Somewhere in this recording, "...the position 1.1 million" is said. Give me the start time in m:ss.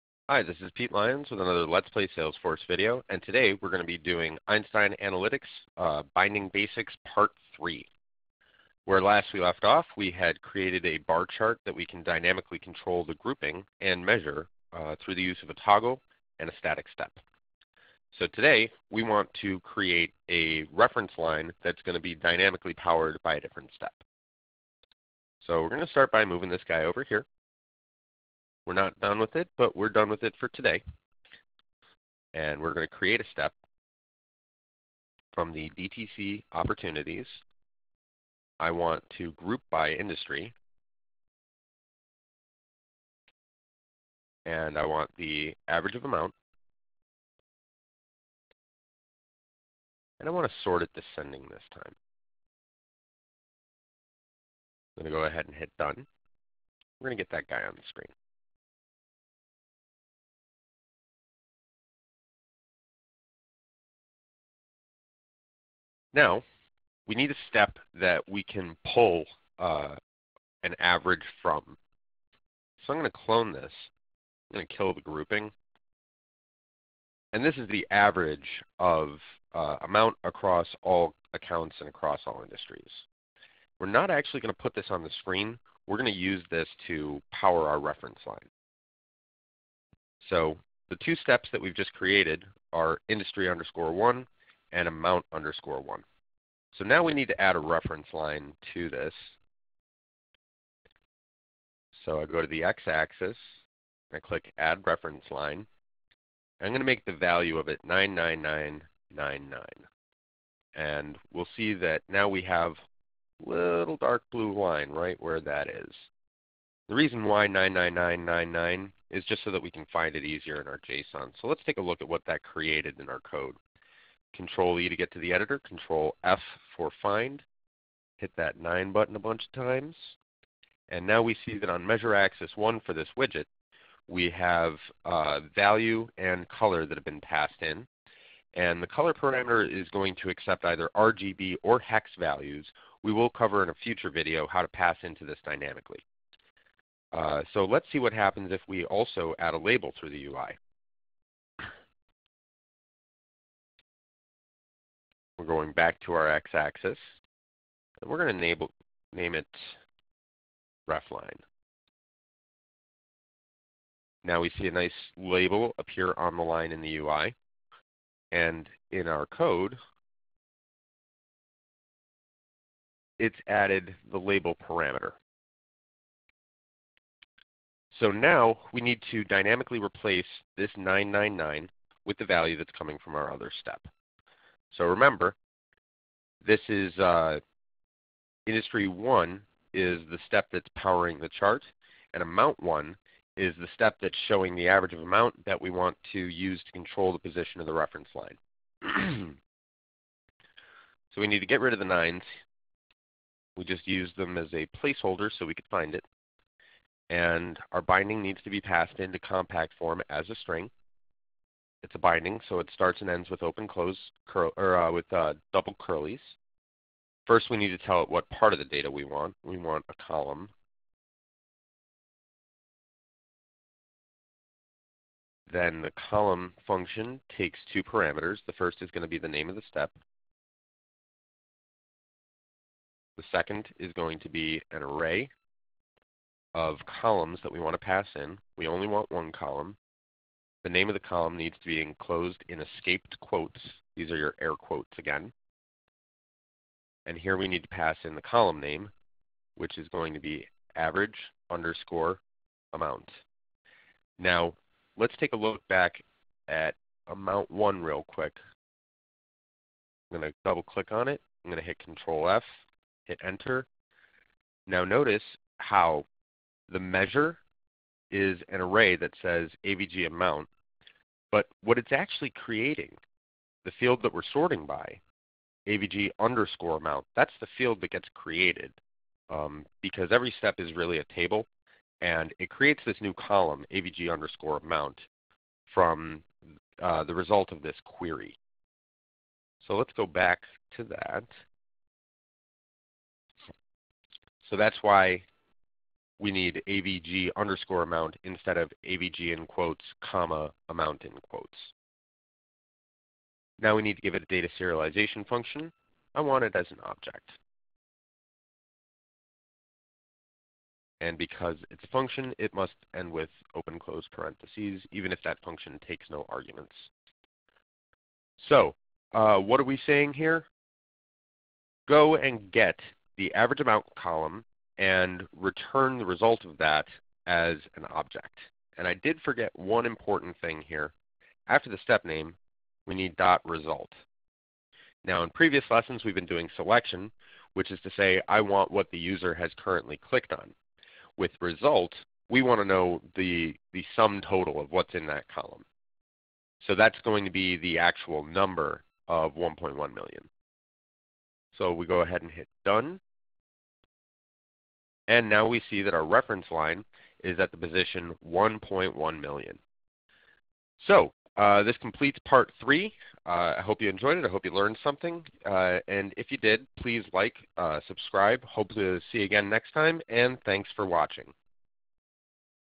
5:57.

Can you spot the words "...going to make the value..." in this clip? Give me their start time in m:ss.
1:46.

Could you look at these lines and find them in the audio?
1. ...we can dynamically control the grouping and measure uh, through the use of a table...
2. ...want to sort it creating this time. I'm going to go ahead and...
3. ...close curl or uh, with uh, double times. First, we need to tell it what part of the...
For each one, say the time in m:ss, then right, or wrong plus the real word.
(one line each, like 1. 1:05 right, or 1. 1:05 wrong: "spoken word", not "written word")
1. 0:11 wrong: "toggle", not "table"
2. 0:50 wrong: "descending", not "creating"
3. 3:33 wrong: "curlies", not "times".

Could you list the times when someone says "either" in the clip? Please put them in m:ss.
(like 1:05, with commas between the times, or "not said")
2:20.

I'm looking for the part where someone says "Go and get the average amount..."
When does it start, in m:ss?
5:21.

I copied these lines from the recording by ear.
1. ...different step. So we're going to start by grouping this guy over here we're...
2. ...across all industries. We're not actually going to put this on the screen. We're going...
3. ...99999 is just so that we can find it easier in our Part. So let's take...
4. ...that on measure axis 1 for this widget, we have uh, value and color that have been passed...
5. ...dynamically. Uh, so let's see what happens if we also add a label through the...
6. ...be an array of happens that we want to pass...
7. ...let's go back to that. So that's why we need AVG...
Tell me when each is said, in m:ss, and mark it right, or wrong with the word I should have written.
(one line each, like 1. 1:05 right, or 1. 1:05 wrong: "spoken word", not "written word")
1. 0:23 wrong: "moving", not "grouping"
2. 1:21 right
3. 1:57 wrong: "JSON", not "Part"
4. 2:11 right
5. 2:25 right
6. 3:54 wrong: "columns", not "happens"
7. 4:49 right.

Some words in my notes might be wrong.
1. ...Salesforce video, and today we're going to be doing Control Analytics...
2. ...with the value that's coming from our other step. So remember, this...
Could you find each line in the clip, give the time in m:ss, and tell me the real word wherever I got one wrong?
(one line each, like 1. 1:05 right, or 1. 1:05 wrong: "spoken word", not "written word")
1. 0:02 wrong: "Einstein", not "Control"
2. 3:02 right.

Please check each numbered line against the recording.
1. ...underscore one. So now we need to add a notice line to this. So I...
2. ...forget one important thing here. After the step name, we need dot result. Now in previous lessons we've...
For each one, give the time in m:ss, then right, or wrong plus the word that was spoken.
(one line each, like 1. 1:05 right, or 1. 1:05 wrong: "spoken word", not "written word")
1. 1:35 wrong: "reference", not "notice"
2. 5:29 right.